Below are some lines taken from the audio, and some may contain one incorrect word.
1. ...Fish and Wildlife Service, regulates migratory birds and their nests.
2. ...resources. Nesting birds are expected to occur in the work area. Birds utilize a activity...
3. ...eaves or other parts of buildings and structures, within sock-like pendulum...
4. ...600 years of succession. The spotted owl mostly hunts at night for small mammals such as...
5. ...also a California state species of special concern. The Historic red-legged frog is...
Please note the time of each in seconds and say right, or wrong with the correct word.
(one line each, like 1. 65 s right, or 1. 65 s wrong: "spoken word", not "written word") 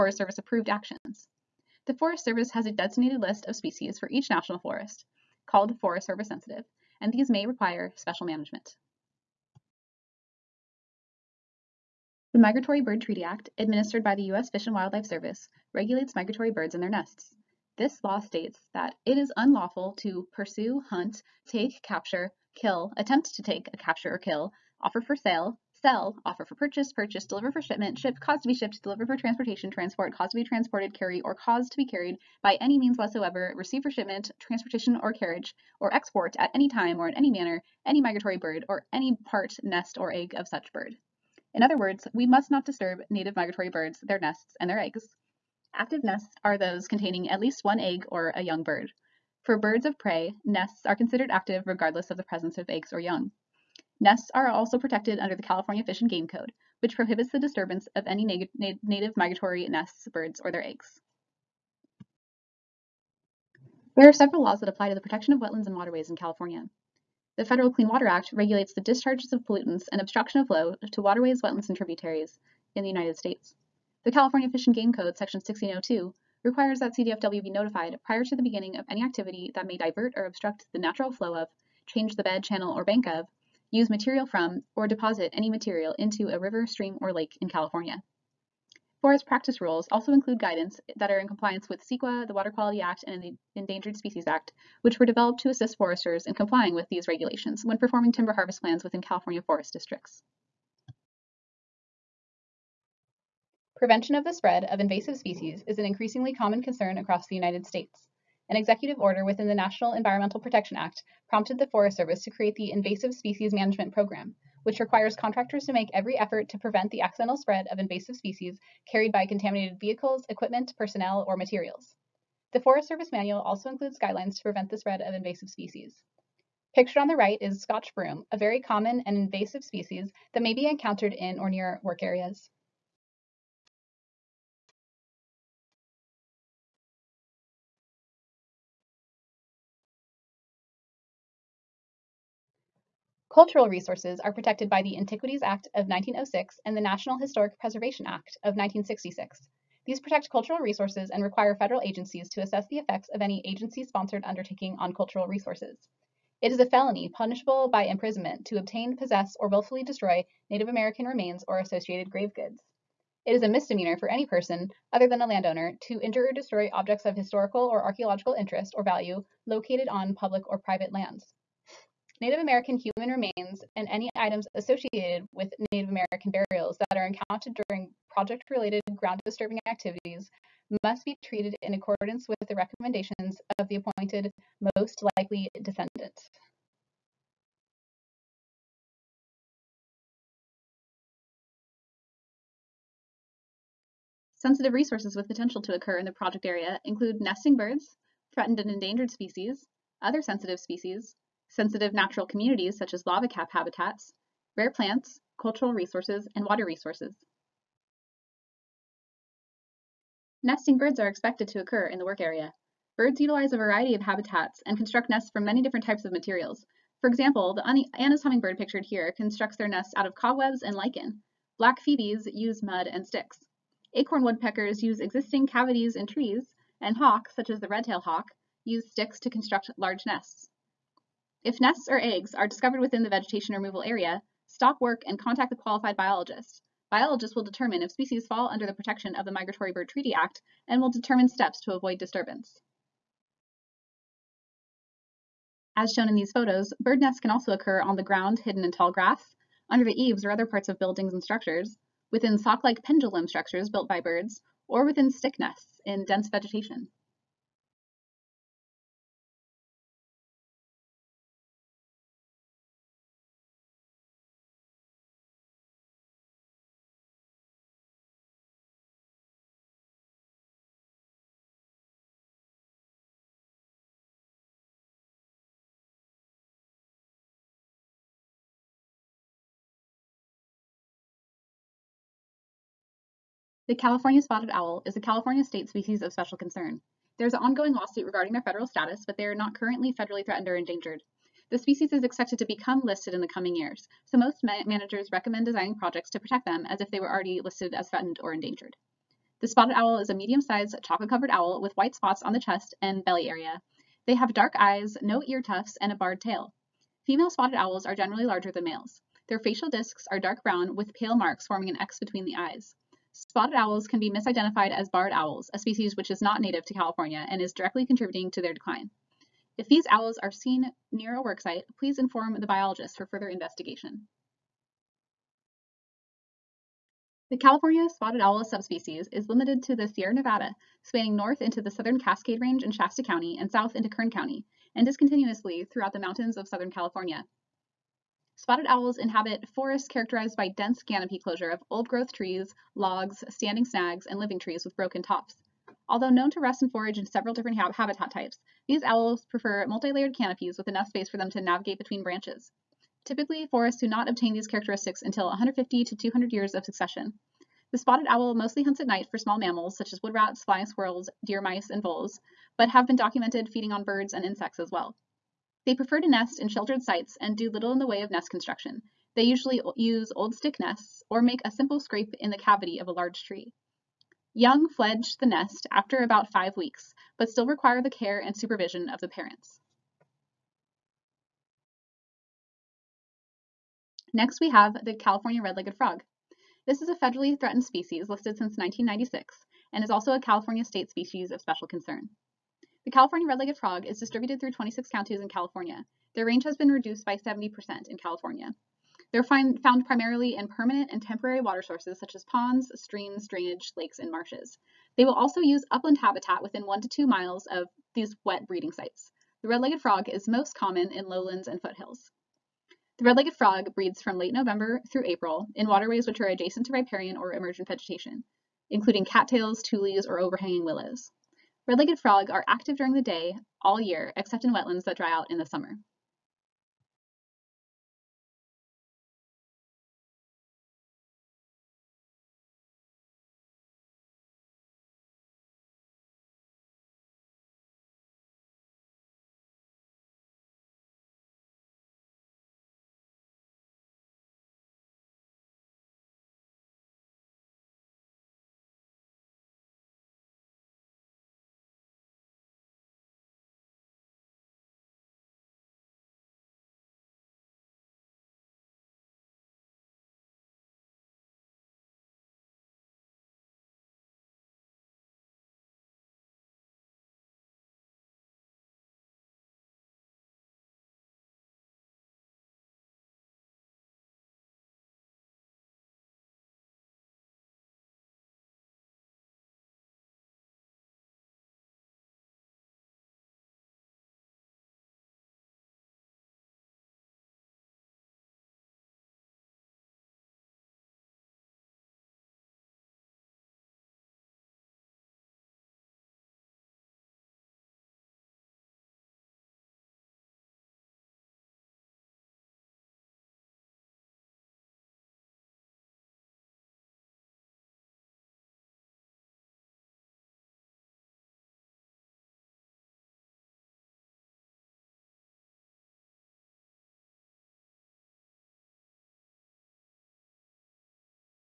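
1. 14 s right
2. 206 s wrong: "variety", not "activity"
3. 249 s right
4. 355 s wrong: "200", not "600"
5. 389 s wrong: "California", not "Historic".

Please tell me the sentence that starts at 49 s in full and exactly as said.
For birds of prey, nests are considered active regardless of the presence of eggs or young.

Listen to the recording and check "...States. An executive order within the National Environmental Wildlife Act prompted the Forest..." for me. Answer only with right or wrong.
wrong.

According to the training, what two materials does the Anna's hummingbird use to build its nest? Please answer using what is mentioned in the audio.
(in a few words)
cobwebs and lichen.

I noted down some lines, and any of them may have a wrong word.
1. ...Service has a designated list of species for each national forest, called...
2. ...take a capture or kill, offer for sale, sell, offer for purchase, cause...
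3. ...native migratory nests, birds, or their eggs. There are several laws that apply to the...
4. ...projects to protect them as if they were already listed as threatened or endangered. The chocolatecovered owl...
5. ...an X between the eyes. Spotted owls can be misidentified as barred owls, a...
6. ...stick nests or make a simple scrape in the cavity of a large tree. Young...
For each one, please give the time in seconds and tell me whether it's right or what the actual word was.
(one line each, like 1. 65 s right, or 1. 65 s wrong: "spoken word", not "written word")
1. 2 s right
2. 23 s wrong: "purchase", not "cause"
3. 58 s right
4. 295 s wrong: "spotted", not "chocolatecovered"
5. 311 s right
6. 370 s right.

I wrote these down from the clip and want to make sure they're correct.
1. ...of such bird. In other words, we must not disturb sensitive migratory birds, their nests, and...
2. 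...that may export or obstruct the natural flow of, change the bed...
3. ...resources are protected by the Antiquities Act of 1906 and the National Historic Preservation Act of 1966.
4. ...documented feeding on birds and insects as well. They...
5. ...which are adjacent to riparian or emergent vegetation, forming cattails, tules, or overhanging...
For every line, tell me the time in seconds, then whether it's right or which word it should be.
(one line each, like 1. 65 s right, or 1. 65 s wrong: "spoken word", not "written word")
1. 40 s wrong: "native", not "sensitive"
2. 79 s wrong: "divert", not "export"
3. 143 s right
4. 362 s right
5. 416 s wrong: "including", not "forming".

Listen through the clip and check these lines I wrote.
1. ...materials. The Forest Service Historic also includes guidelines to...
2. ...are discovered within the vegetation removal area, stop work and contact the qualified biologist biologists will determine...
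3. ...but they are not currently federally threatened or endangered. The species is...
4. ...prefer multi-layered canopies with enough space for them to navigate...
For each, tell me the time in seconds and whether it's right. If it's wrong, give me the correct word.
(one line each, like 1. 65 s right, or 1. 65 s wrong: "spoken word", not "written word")
1. 121 s wrong: "Manual", not "Historic"
2. 232 s right
3. 289 s right
4. 349 s right.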